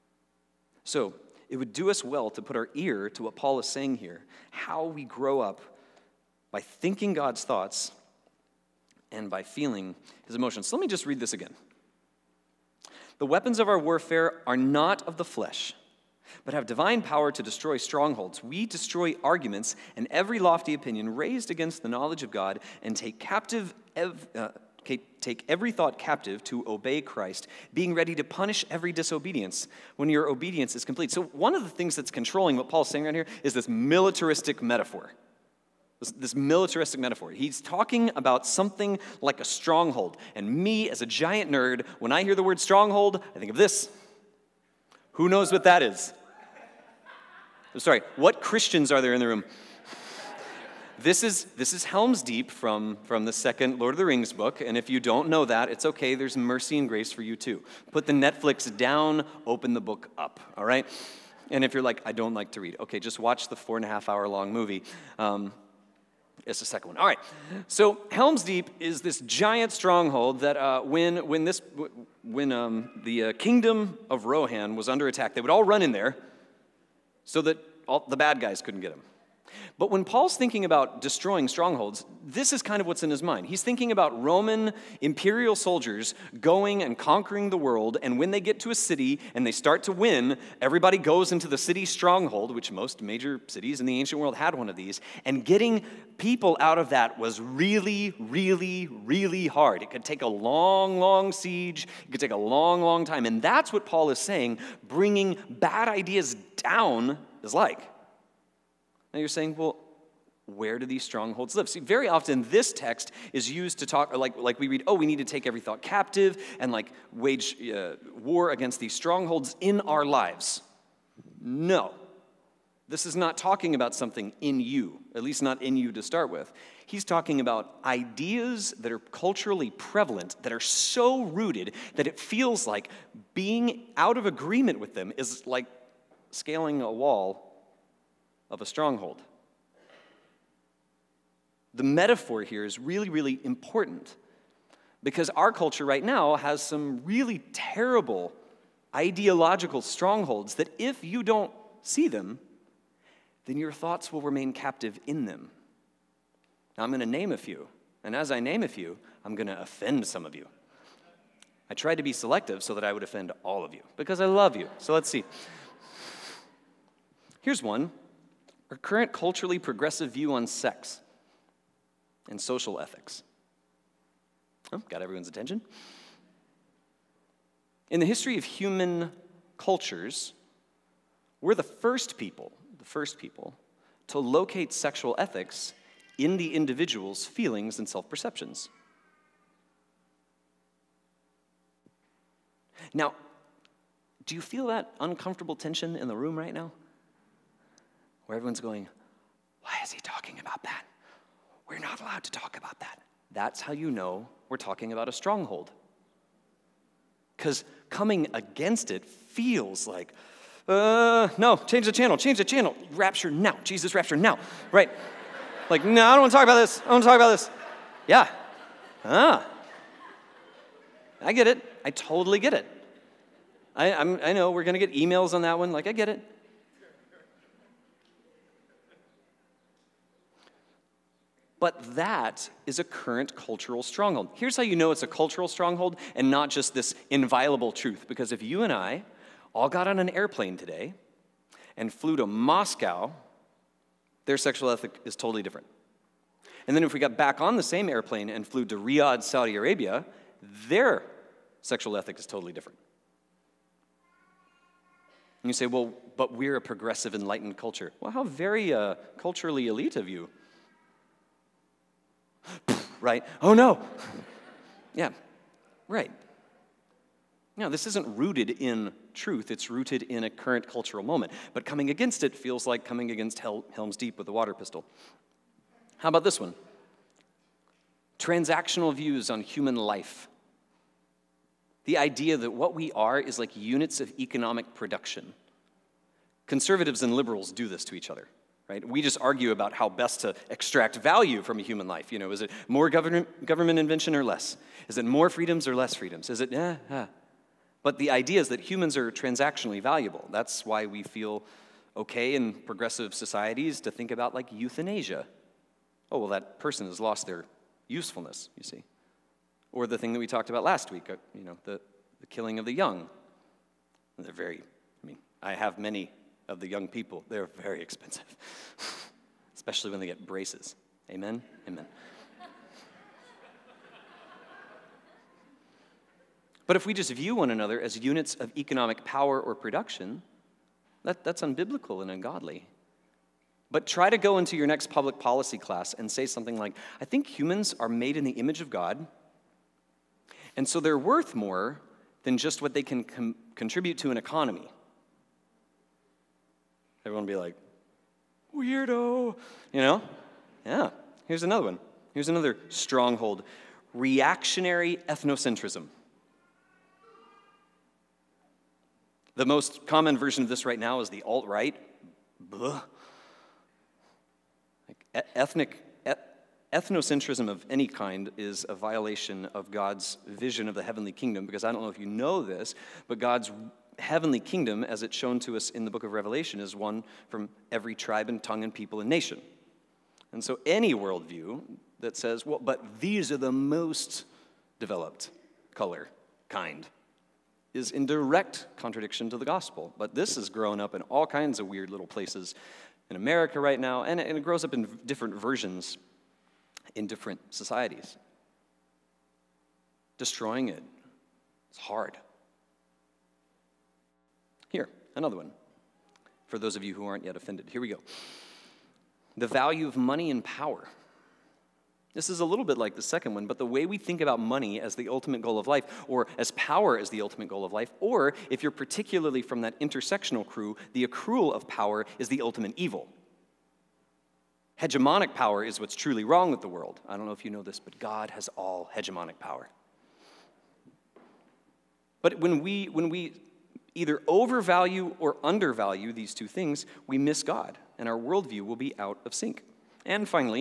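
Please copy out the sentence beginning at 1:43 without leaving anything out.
And that's what Paul is saying bringing bad ideas down is like.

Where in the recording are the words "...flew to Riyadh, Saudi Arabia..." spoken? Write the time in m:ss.
4:08.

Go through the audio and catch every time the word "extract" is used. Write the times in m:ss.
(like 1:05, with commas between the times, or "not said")
4:50.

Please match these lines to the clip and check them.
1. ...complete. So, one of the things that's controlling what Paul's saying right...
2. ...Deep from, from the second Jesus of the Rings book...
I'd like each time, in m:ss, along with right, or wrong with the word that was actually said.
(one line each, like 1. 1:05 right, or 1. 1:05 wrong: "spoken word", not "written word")
1. 0:30 right
2. 0:52 wrong: "Lord", not "Jesus".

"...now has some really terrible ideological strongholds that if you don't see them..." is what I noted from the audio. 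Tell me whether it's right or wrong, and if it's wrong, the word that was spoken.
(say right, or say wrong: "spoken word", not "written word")
right.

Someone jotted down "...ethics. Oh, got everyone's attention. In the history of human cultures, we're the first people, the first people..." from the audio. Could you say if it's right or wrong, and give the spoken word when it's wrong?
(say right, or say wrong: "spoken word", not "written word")
right.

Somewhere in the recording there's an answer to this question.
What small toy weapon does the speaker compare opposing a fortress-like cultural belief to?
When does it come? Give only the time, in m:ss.
4:34.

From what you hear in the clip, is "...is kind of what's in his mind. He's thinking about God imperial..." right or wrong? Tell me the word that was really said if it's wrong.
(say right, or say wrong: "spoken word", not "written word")
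wrong: "Roman", not "God".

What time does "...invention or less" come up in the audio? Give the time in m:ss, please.
4:53.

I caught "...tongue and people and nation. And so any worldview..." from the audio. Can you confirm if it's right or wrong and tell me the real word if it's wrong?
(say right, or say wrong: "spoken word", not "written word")
right.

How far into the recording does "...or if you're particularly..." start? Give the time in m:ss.
6:57.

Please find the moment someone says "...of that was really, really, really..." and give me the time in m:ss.
1:36.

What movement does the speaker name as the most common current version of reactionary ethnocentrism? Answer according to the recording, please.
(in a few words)
the alt right.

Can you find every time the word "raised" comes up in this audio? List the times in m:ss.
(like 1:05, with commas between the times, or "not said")
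0:21.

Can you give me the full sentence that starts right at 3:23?
That's how you know we're talking about a stronghold.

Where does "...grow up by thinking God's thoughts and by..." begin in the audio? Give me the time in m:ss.
0:05.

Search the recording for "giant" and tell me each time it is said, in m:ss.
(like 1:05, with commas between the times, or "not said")
0:41, 1:09.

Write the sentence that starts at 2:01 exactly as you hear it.
No, this is not talking about something in you, at least not in you to start with.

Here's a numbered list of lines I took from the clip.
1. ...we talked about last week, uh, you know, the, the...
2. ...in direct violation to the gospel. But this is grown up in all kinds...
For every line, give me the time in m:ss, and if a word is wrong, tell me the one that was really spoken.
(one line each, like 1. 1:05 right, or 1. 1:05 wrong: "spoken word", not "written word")
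1. 5:10 right
2. 6:27 wrong: "contradiction", not "violation".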